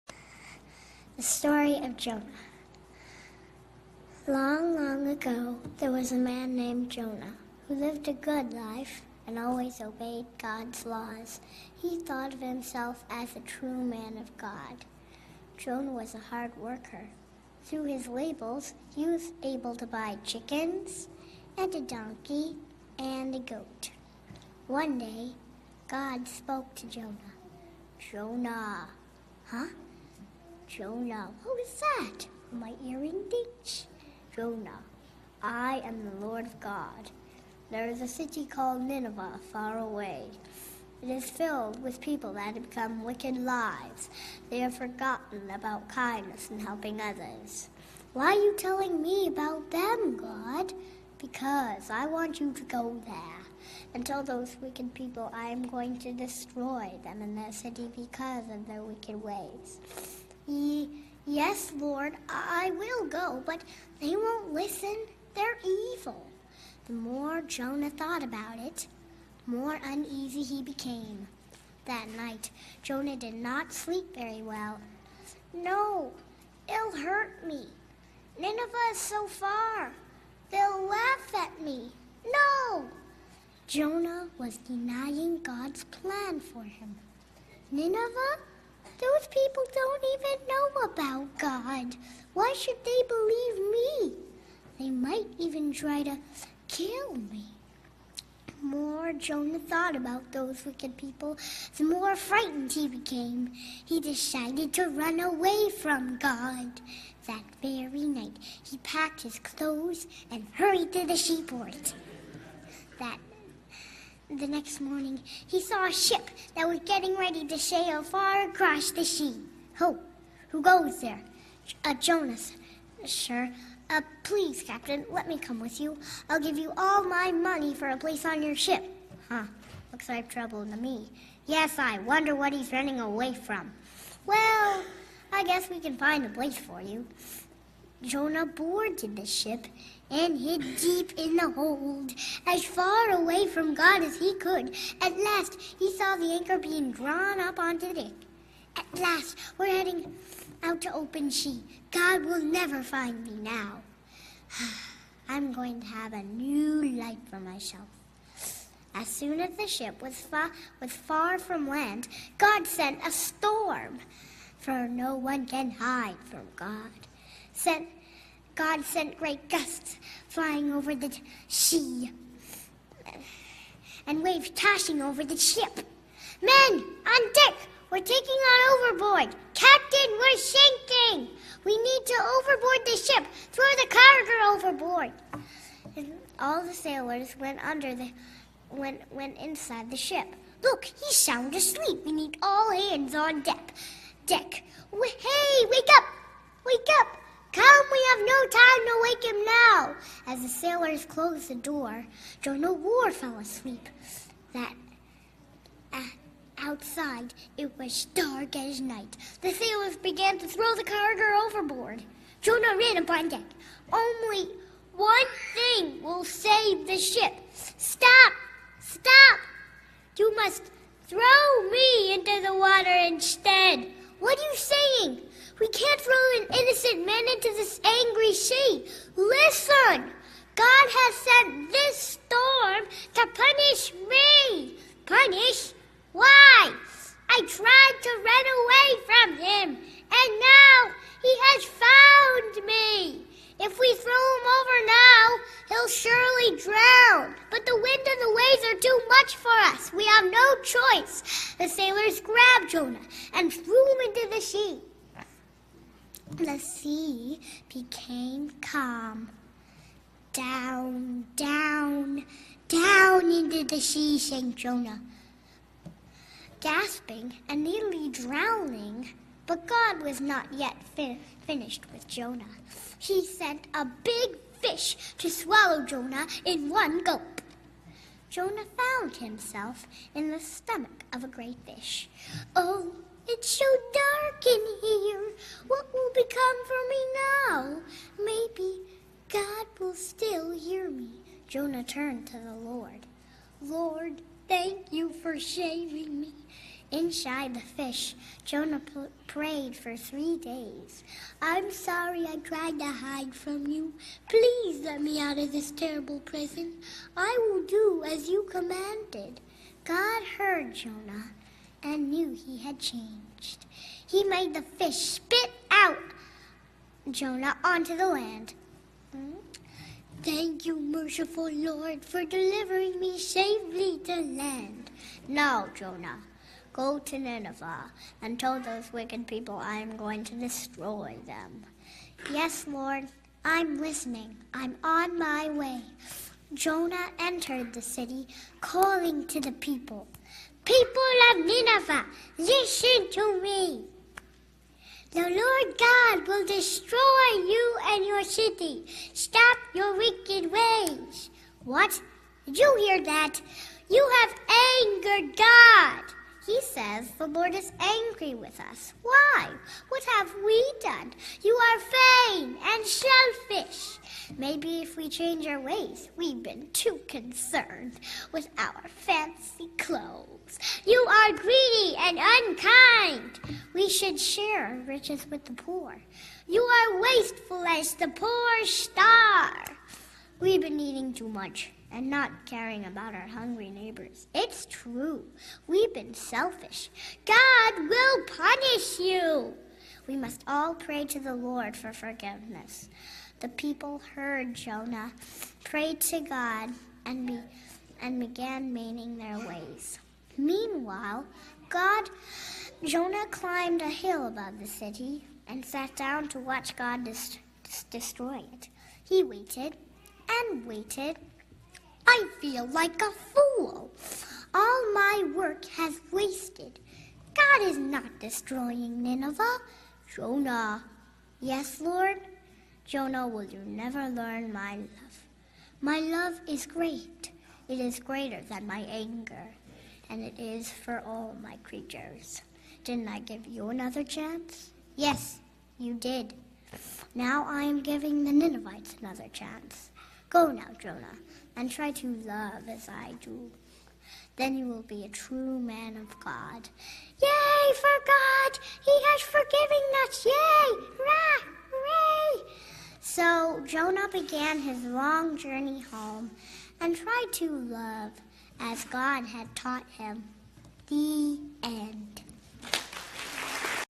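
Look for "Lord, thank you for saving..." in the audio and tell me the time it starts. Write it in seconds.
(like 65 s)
293 s.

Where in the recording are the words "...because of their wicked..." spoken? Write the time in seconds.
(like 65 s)
57 s.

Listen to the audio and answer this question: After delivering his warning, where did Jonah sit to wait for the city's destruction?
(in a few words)
A hill above the city.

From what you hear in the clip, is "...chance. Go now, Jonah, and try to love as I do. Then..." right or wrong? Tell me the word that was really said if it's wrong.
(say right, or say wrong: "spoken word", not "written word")
right.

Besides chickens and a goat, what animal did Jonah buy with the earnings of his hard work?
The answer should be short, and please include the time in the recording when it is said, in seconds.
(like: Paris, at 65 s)
A donkey, at 21 s.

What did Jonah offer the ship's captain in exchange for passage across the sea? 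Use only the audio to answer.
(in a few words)
All my money.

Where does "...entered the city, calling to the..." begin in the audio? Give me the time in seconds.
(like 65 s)
337 s.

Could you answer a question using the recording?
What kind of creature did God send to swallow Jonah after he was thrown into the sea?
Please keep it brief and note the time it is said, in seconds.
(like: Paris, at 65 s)
A big fish, at 273 s.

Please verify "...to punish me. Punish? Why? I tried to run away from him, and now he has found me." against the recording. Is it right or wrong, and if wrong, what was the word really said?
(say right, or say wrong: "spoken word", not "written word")
right.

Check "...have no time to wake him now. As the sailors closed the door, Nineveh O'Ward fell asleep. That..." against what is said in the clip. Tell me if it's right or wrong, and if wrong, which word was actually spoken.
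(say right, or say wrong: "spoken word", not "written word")
wrong: "Jonah", not "Nineveh".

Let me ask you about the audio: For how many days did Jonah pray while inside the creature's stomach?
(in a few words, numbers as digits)
3.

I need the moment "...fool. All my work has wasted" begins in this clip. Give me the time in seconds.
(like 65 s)
413 s.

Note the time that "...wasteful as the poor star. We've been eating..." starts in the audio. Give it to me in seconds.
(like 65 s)
377 s.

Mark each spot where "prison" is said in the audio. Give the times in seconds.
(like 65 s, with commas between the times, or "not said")
306 s.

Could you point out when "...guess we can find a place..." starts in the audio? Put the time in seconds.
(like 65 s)
135 s.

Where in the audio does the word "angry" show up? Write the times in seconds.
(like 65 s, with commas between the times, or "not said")
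227 s, 357 s.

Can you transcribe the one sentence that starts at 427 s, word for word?
It is greater than my anger, and it is for all my creatures.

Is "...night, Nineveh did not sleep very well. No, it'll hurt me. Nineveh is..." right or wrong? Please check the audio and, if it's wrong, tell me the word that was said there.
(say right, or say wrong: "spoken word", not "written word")
wrong: "Jonah", not "Nineveh".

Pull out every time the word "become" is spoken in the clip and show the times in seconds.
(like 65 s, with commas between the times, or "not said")
42 s, 286 s.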